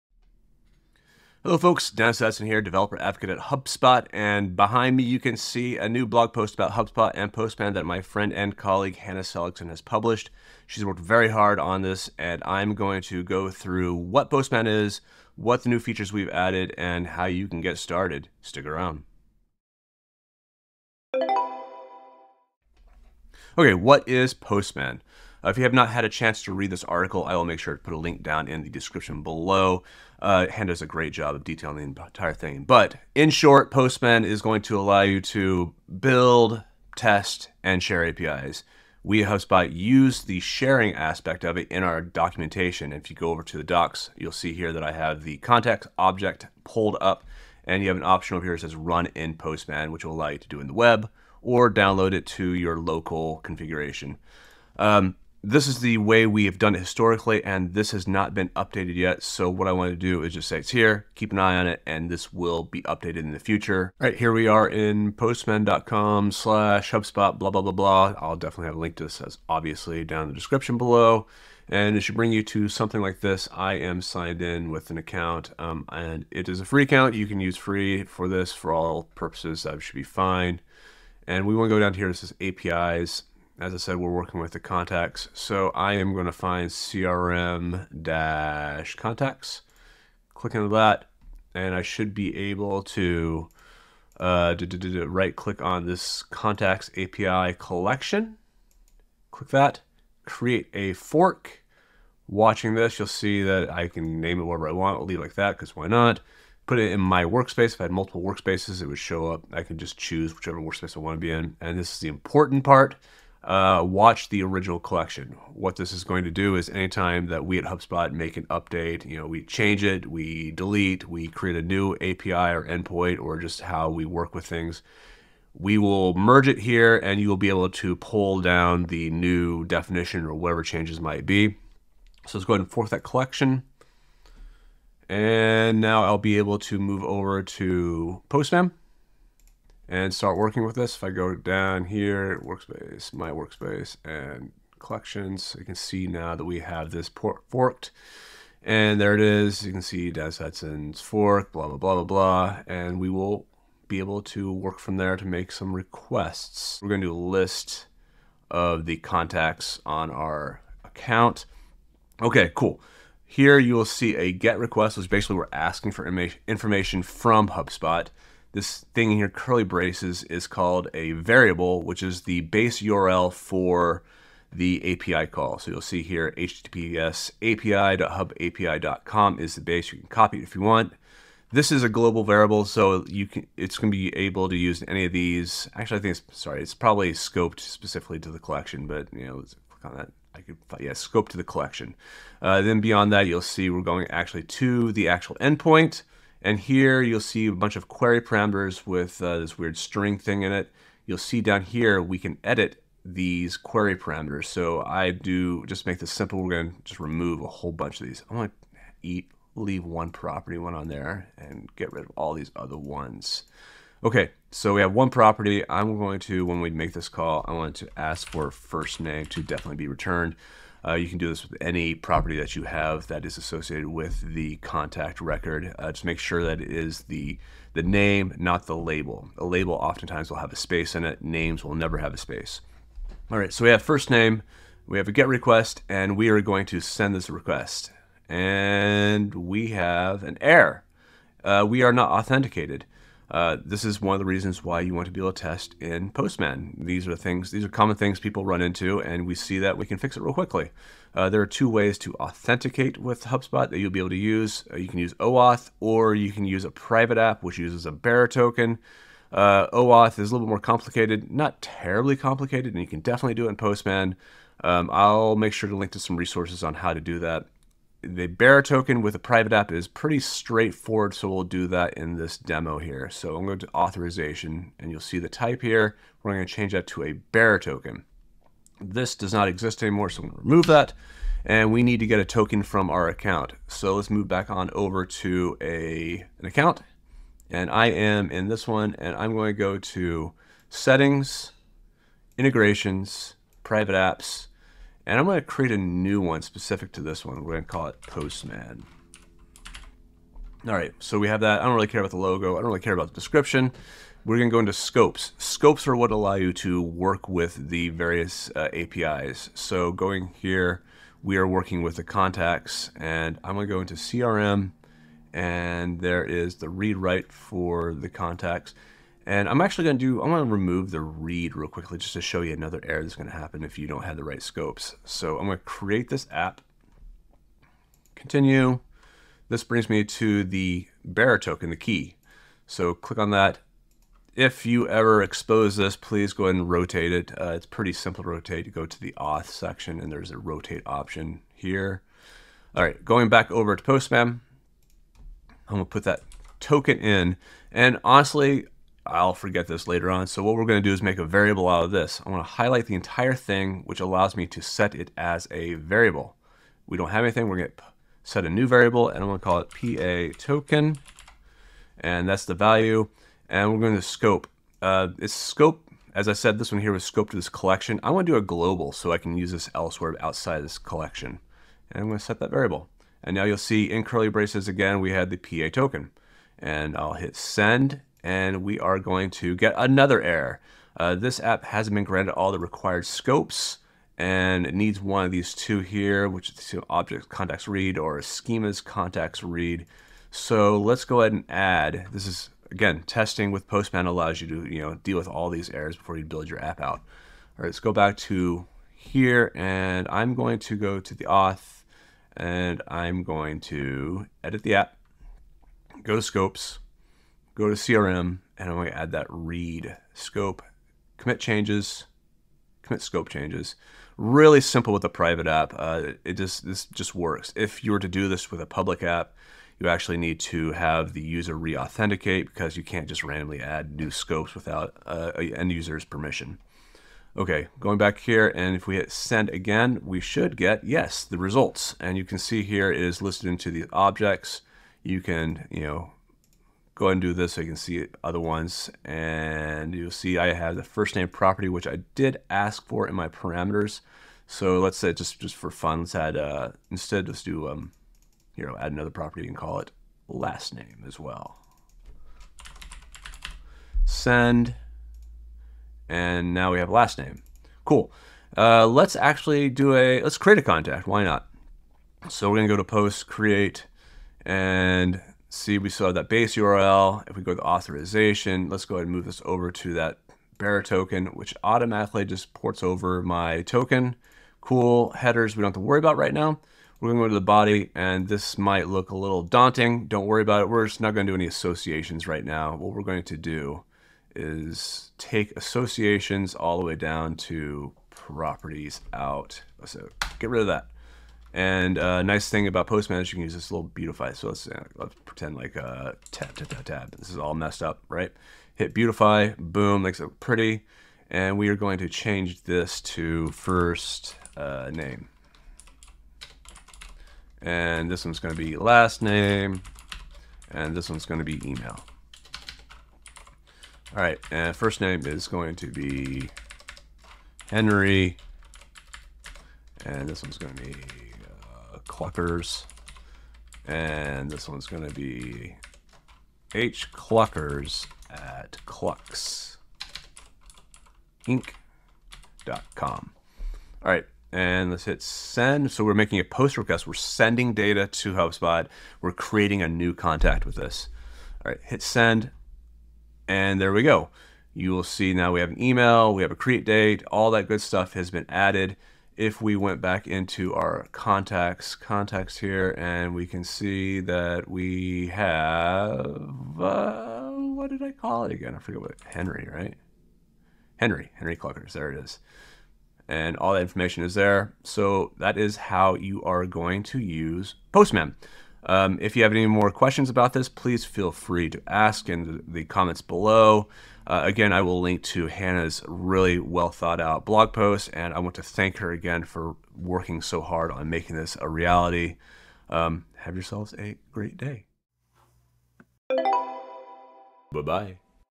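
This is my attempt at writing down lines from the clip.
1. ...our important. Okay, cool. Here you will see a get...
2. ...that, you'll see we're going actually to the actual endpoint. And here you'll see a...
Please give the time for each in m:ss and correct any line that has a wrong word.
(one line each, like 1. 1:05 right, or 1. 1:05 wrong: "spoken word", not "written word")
1. 2:40 wrong: "account", not "important"
2. 3:13 right.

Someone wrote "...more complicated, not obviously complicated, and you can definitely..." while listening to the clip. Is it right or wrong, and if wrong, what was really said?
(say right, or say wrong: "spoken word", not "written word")
wrong: "terribly", not "obviously".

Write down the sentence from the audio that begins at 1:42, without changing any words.
Watching this, you'll see that I can name it whatever I want.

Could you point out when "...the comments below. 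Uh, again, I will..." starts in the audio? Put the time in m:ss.
9:32.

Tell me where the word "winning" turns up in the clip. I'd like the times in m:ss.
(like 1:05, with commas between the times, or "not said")
not said.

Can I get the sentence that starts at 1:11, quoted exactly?
And it should bring you to something like this.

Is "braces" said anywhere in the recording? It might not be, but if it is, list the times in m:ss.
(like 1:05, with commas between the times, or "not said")
2:49, 6:14.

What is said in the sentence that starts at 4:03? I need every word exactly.
Uh, this is one of the reasons why you want to be able to test in Postman.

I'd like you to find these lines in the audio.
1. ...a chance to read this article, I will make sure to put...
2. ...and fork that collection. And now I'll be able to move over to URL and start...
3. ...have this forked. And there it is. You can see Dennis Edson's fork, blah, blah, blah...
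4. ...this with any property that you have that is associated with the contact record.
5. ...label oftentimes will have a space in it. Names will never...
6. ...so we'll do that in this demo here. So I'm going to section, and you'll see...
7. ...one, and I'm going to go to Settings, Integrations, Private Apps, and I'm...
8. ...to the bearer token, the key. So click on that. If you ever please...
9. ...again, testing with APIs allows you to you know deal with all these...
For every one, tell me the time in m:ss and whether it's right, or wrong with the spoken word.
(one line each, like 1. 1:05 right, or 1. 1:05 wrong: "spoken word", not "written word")
1. 0:26 right
2. 2:12 wrong: "Postman", not "URL"
3. 2:26 right
4. 3:41 right
5. 3:49 right
6. 4:31 wrong: "authorization", not "section"
7. 4:48 right
8. 5:30 wrong: "expose", not "please"
9. 6:32 wrong: "Postman", not "APIs".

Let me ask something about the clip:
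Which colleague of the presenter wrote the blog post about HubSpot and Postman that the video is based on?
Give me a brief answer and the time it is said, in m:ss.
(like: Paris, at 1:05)
Hannah Seligson, at 0:08.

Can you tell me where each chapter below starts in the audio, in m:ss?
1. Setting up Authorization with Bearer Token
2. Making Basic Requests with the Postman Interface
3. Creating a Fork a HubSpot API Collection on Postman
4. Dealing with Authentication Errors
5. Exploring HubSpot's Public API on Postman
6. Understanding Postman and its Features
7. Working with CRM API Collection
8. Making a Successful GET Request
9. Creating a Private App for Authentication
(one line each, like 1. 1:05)
1. 4:35
2. 2:39
3. 1:35
4. 4:03
5. 1:05
6. 0:23
7. 2:18
8. 7:09
9. 4:49.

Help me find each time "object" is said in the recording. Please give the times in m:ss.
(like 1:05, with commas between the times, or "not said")
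0:45, 6:26, 7:13.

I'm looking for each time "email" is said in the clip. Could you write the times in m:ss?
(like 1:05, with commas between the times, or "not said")
8:31, 9:05.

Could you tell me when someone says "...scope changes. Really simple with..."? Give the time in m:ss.
6:53.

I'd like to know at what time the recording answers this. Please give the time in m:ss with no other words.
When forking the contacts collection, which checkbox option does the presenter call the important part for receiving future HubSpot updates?
1:53.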